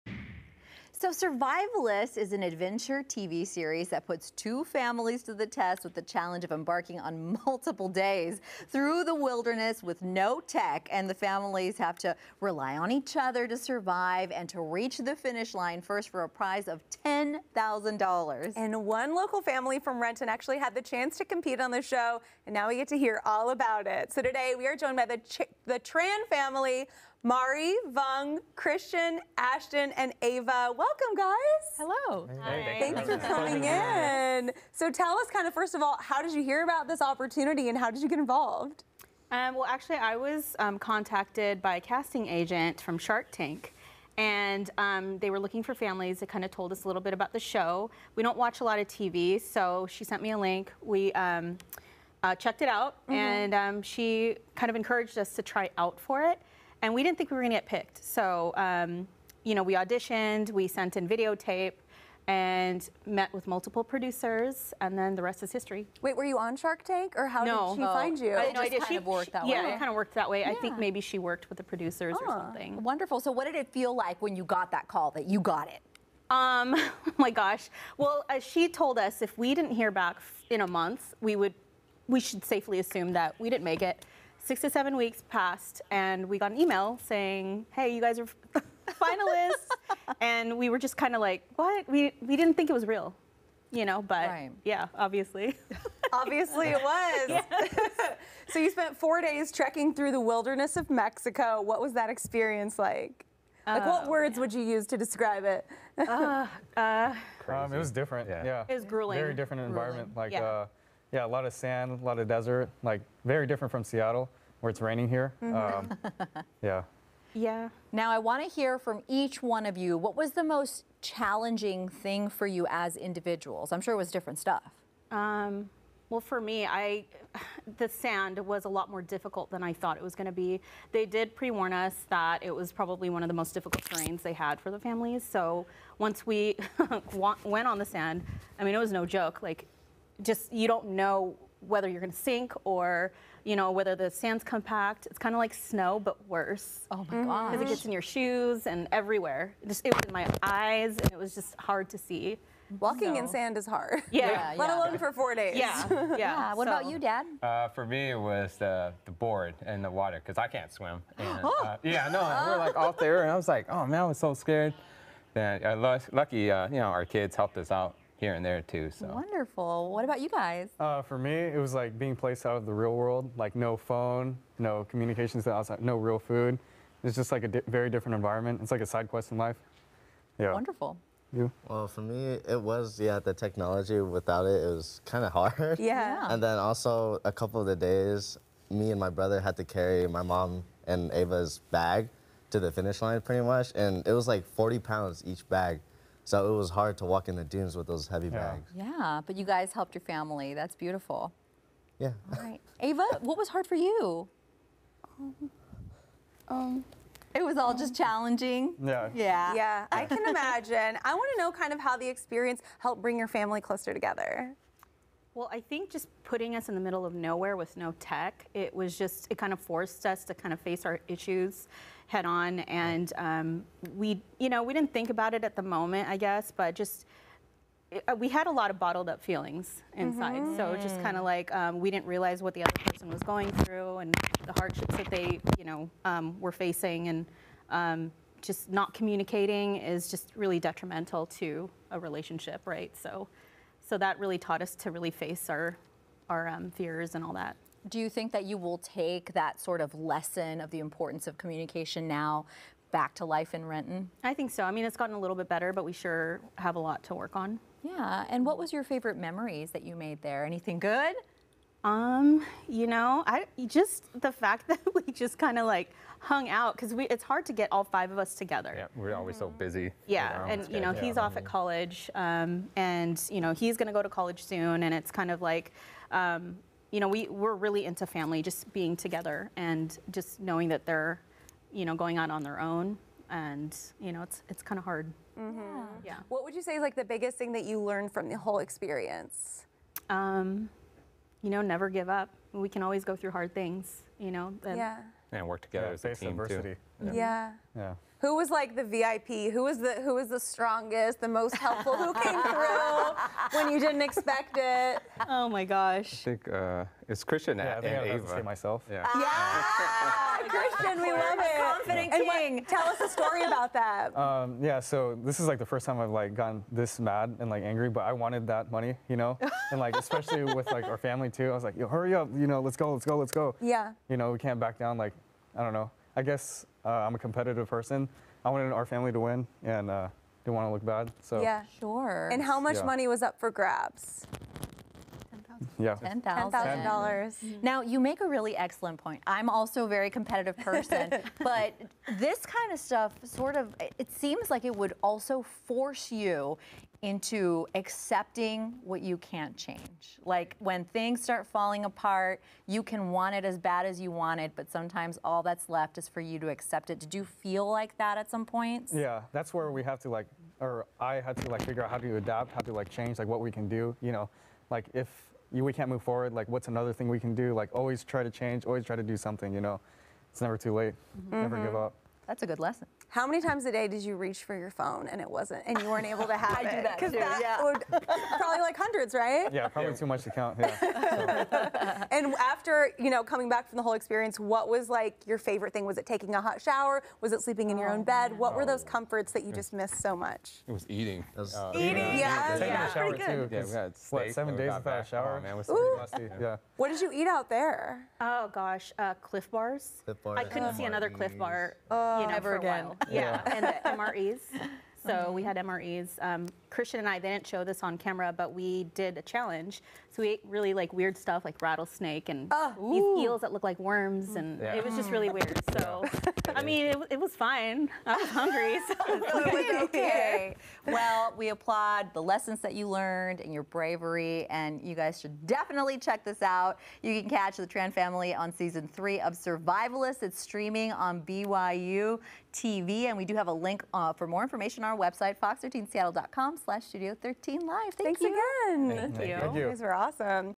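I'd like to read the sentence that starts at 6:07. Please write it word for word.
Like always try to change, always try to do something, you know?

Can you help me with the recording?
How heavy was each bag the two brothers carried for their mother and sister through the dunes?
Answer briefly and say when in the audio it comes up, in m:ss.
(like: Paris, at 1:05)
40 pounds, at 3:14.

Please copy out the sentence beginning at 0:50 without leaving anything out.
We um, uh, checked it out, mm -hmm.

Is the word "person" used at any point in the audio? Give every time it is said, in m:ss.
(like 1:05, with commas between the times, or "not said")
3:52, 5:27, 5:40.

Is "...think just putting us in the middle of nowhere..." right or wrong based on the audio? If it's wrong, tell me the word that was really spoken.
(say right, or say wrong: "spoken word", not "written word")
right.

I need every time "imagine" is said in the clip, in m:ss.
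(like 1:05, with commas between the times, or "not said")
3:30.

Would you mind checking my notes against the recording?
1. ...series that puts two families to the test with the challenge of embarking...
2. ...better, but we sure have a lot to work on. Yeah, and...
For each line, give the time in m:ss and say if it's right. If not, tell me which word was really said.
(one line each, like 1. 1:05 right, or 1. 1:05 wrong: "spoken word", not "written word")
1. 0:03 right
2. 4:15 right.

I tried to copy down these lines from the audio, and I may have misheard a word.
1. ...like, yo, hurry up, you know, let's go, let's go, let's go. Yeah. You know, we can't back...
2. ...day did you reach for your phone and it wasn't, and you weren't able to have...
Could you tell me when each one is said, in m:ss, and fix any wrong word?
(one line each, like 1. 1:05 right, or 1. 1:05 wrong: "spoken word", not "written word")
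1. 5:21 right
2. 6:13 right.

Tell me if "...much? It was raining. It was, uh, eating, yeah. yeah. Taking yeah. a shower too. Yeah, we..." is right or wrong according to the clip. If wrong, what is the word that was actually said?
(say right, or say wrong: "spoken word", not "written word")
wrong: "eating", not "raining".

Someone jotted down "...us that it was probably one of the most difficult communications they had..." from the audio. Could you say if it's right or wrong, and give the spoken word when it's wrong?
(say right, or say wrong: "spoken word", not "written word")
wrong: "terrains", not "communications".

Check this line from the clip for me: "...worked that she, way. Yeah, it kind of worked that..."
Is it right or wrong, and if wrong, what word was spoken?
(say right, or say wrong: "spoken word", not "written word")
right.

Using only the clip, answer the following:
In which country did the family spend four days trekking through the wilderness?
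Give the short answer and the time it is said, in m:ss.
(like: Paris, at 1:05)
Mexico, at 1:40.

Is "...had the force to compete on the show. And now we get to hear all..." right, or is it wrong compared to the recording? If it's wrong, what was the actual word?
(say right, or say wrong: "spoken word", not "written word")
wrong: "chance", not "force".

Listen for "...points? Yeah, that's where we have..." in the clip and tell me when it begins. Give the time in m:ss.
5:58.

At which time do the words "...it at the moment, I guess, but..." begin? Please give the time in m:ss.
3:45.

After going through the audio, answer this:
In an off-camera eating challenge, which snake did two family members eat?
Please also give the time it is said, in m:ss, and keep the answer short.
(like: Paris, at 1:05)
Rattlesnake, at 6:51.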